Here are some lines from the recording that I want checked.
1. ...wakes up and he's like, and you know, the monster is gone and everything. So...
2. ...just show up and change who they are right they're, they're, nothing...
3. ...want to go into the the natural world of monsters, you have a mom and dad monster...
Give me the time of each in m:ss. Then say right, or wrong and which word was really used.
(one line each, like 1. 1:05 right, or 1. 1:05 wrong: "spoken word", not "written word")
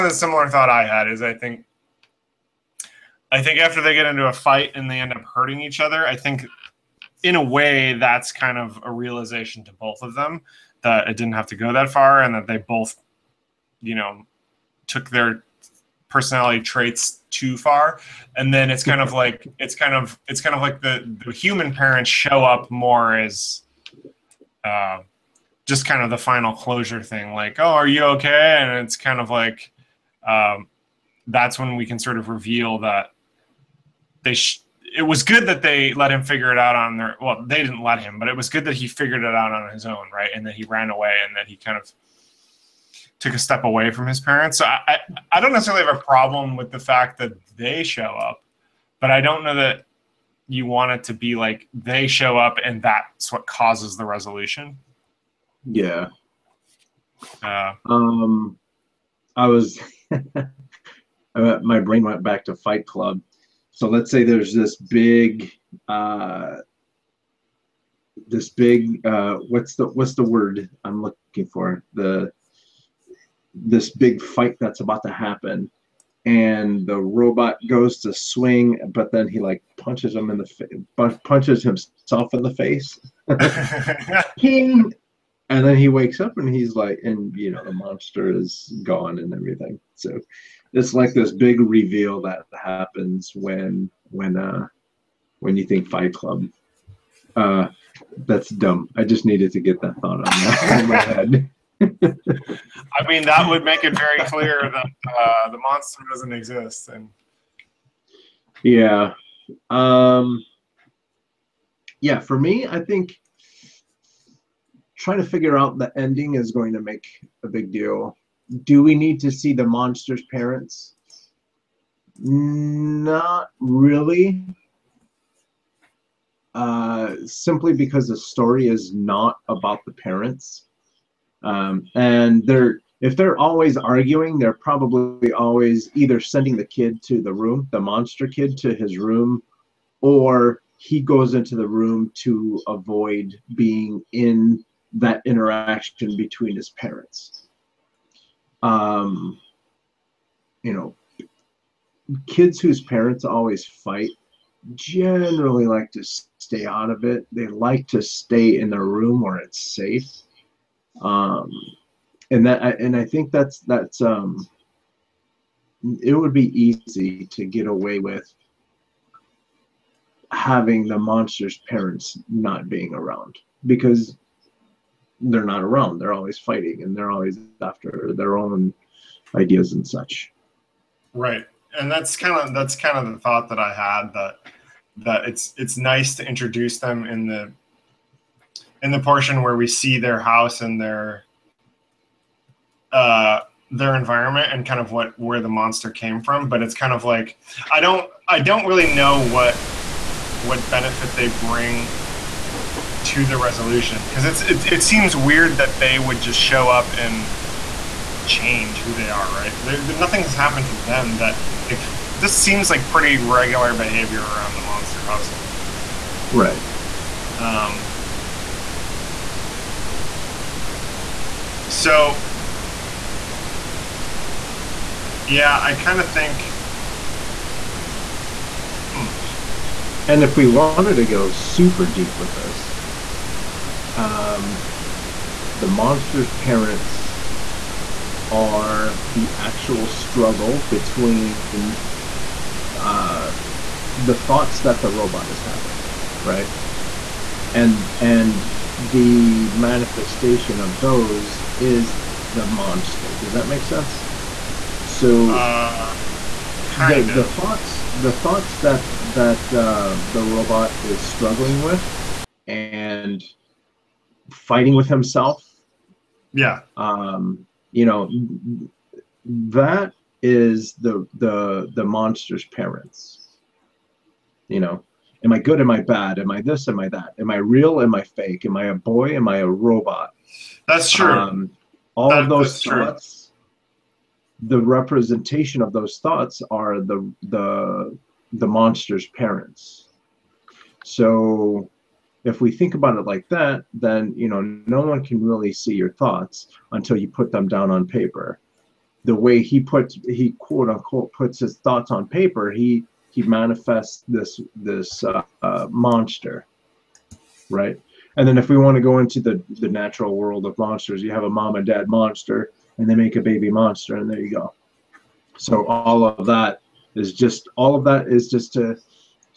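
1. 1:25 right
2. 3:26 right
3. 5:08 right.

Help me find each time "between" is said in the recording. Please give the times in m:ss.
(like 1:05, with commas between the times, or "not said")
2:26, 4:00.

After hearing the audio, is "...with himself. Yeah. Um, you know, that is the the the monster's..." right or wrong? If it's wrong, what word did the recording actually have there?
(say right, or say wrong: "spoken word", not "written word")
right.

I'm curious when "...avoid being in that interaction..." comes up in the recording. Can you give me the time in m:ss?
2:22.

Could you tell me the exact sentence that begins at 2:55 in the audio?
They're always fighting and they're always after their own ideas and such.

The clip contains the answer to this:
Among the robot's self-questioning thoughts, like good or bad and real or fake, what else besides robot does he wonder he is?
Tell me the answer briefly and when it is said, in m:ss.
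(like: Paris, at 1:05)
A boy, at 4:38.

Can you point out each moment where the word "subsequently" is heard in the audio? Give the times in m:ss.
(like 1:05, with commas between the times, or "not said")
not said.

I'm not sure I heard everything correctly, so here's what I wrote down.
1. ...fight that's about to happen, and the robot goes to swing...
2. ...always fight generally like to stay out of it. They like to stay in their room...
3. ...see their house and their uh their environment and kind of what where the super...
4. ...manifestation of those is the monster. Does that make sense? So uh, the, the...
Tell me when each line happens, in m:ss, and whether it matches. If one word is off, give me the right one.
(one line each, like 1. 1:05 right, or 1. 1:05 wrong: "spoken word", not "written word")
1. 1:14 right
2. 2:33 right
3. 3:09 wrong: "monster", not "super"
4. 4:09 right.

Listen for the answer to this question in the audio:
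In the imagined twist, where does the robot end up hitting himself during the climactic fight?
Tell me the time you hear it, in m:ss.
1:21.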